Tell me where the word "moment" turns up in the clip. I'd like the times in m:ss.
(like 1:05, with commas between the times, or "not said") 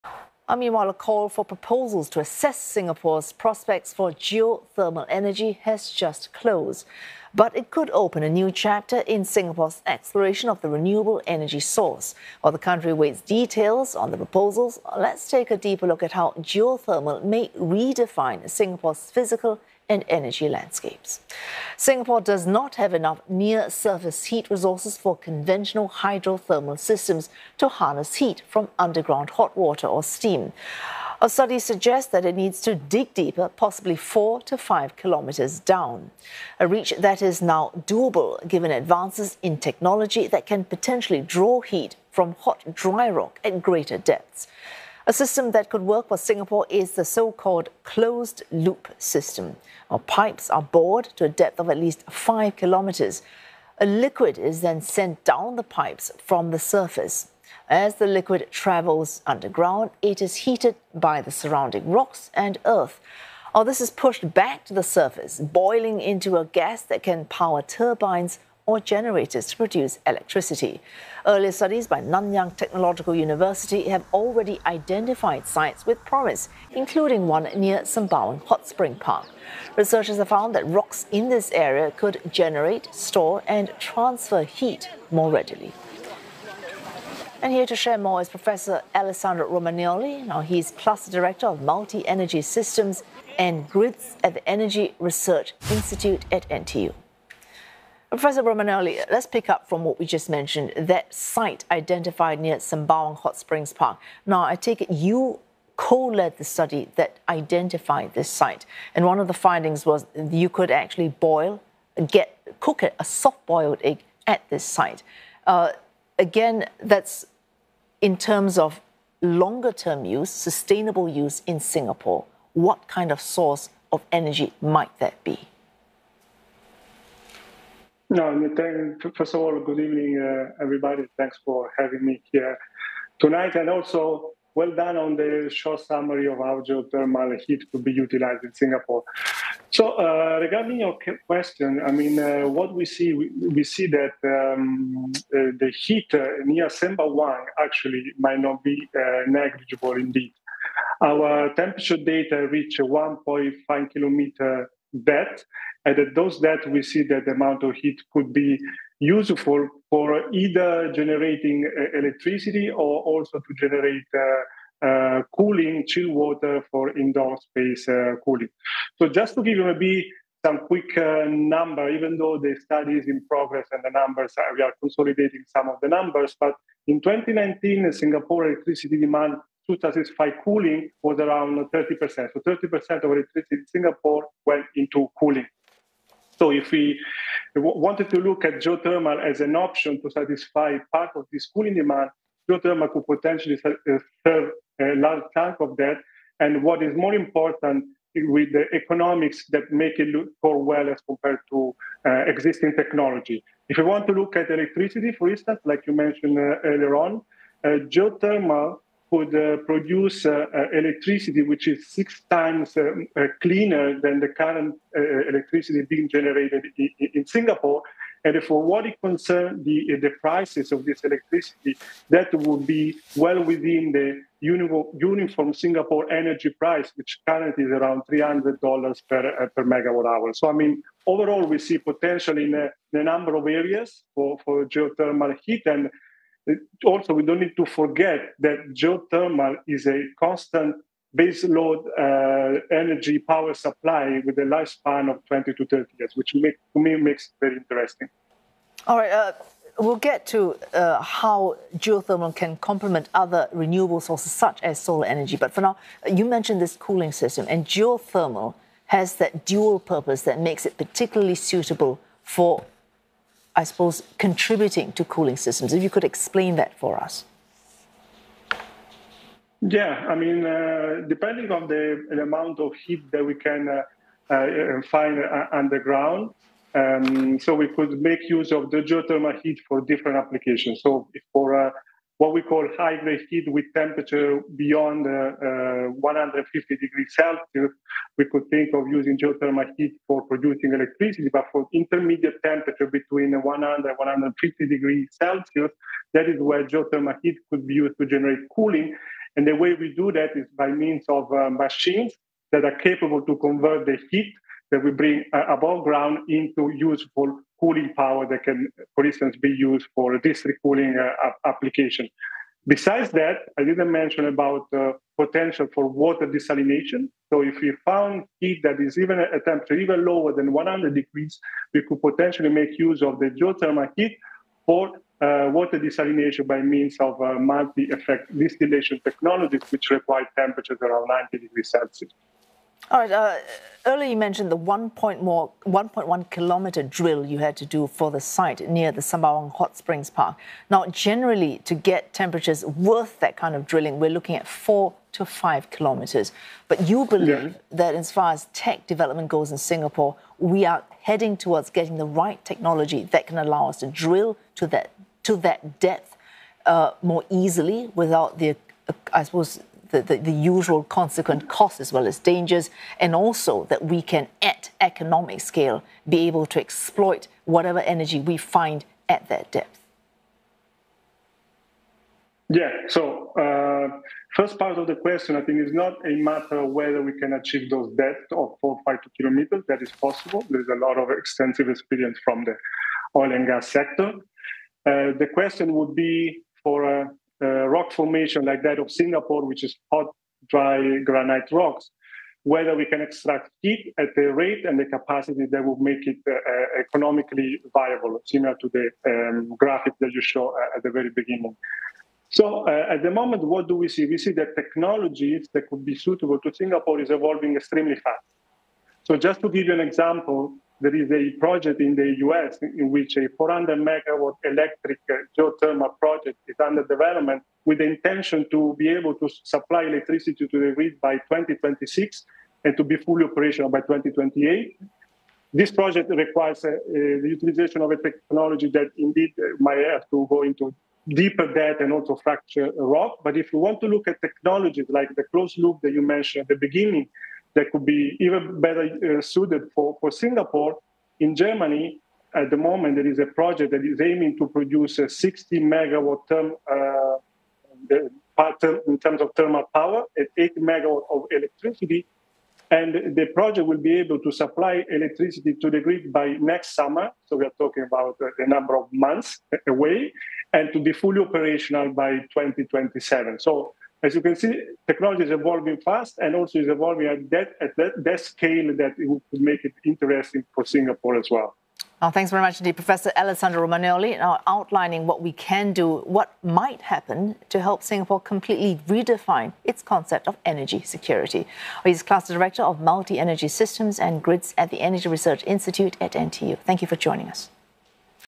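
6:43, 7:22.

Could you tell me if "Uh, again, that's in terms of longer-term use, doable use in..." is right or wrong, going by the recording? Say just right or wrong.
wrong.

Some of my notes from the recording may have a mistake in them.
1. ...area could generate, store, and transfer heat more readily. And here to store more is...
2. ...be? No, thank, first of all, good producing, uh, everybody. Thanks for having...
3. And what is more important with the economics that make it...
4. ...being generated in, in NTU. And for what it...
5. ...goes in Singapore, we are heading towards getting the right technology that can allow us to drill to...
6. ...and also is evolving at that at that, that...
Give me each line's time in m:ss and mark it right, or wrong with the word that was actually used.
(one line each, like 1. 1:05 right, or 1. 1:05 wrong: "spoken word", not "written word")
1. 1:21 wrong: "share", not "store"
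2. 2:05 wrong: "evening", not "producing"
3. 3:16 right
4. 3:35 wrong: "Singapore", not "NTU"
5. 5:49 right
6. 7:46 right.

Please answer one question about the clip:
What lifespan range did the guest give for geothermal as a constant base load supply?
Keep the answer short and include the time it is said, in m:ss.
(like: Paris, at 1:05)
20 to 30 years, at 4:05.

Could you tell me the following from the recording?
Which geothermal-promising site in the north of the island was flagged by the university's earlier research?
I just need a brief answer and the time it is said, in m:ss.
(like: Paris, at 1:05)
Sembawang Hot Spring Park, at 1:17.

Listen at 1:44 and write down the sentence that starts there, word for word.
Now, I take it you co-led the study that identified this site.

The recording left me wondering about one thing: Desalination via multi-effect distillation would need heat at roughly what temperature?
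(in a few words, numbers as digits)
90 degrees Celsius.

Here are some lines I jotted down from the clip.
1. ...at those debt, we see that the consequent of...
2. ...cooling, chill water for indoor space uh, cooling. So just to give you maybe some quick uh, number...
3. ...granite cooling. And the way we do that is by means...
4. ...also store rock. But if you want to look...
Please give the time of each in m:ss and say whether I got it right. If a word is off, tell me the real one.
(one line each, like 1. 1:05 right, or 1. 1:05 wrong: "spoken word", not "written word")
1. 2:35 wrong: "amount", not "consequent"
2. 2:45 right
3. 4:58 wrong: "generate", not "granite"
4. 7:11 wrong: "fracture", not "store".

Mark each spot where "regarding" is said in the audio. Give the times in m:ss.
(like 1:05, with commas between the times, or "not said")
2:20.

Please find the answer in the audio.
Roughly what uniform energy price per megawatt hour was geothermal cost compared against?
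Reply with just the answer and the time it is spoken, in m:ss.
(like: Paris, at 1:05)
$300, at 3:48.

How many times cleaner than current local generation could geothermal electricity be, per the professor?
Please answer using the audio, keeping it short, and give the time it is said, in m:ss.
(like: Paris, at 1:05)
6 times, at 3:31.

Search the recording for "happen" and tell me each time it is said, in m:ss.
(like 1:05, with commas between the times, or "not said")
7:56.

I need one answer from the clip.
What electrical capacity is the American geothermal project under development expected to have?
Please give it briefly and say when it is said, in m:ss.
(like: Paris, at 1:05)
400 megawatts, at 6:53.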